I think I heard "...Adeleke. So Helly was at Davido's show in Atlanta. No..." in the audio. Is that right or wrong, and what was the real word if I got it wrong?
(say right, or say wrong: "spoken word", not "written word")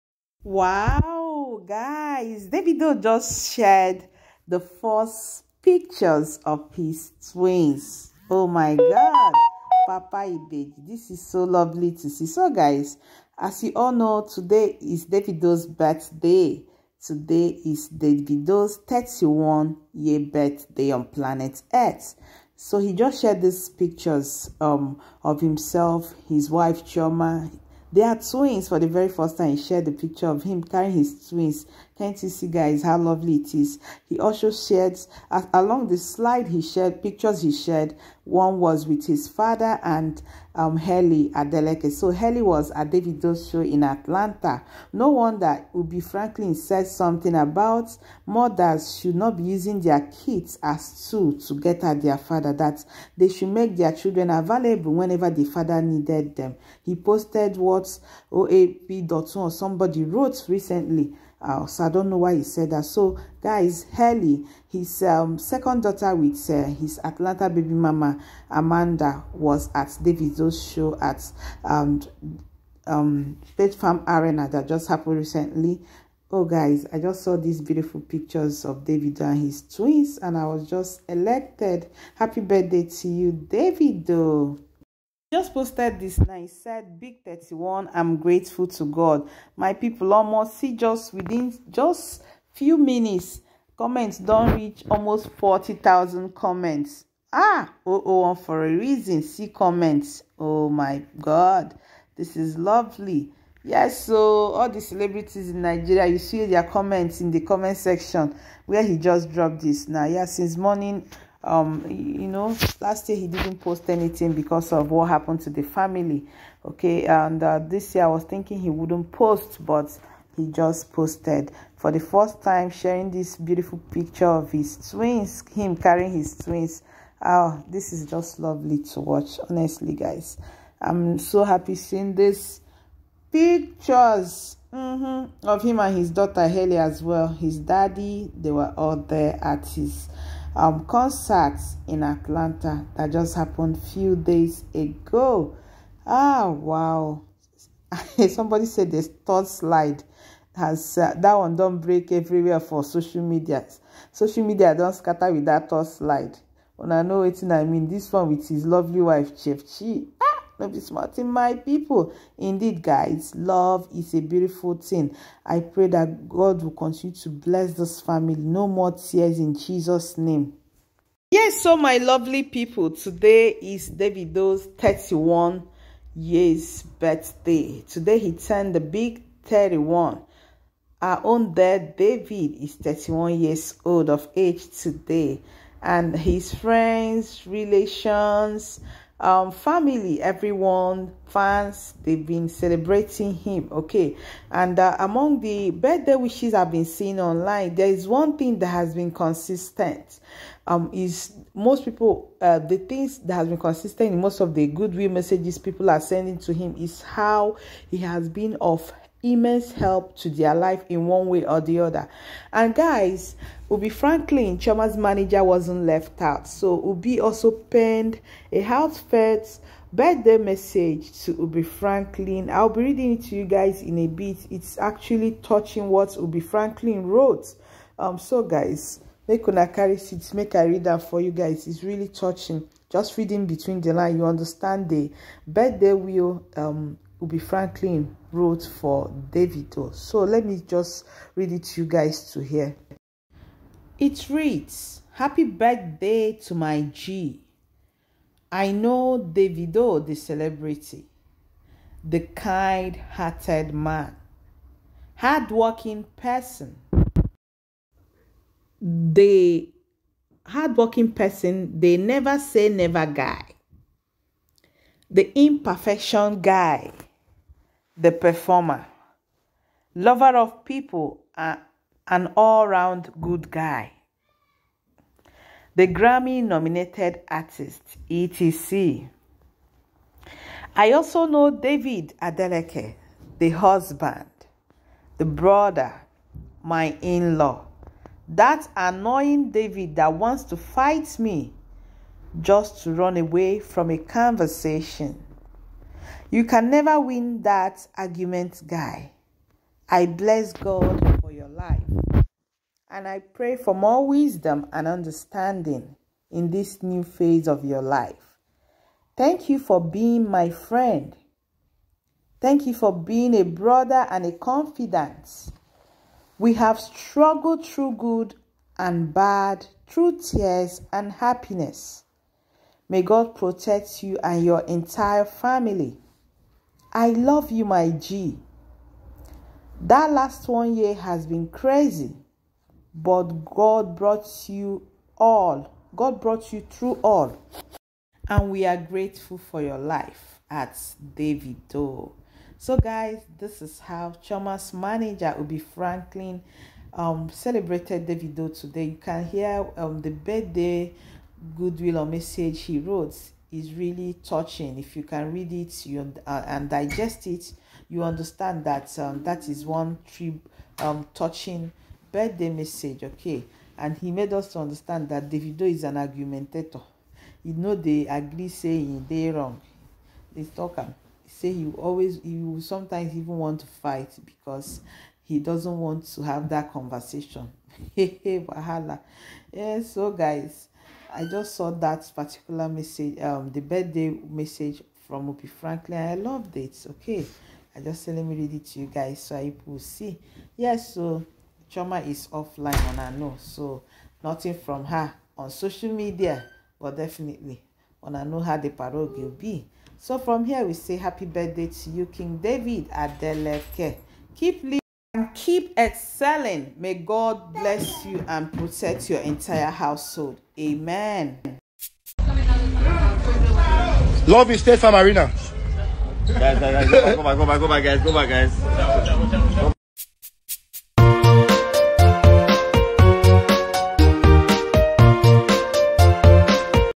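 right.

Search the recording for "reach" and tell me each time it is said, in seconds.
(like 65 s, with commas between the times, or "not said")
94 s.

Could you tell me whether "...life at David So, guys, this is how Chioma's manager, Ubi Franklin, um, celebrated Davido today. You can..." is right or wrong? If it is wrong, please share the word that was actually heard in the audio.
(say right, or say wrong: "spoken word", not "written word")
right.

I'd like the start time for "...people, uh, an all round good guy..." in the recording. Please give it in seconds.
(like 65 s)
270 s.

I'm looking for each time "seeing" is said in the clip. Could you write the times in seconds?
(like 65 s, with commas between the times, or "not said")
131 s, 196 s.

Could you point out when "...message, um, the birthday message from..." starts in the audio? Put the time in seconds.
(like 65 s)
382 s.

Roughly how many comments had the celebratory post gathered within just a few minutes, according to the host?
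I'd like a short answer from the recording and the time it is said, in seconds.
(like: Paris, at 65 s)
40,000, at 95 s.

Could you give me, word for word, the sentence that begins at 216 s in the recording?
So Ubi also penned a heartfelt birthday message to Ubi Franklin.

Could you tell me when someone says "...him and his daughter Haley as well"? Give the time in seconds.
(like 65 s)
135 s.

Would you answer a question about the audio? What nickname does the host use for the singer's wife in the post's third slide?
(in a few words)
Chef Chi.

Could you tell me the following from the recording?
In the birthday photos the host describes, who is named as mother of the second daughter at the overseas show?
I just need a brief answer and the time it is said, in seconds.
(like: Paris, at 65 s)
Amanda, at 68 s.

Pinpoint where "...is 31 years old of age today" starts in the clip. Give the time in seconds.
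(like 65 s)
182 s.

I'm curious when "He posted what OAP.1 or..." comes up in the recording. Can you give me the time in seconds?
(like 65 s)
56 s.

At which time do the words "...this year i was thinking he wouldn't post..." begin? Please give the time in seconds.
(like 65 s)
117 s.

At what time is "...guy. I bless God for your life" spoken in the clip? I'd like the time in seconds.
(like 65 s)
298 s.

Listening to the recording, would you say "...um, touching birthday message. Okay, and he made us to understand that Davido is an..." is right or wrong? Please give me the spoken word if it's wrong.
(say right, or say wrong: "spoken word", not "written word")
right.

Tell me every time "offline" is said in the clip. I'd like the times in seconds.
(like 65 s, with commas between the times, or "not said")
392 s.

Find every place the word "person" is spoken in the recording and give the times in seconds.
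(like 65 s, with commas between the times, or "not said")
256 s, 261 s.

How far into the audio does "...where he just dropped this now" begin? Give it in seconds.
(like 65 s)
108 s.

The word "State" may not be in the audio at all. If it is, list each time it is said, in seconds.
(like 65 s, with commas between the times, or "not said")
73 s, 414 s.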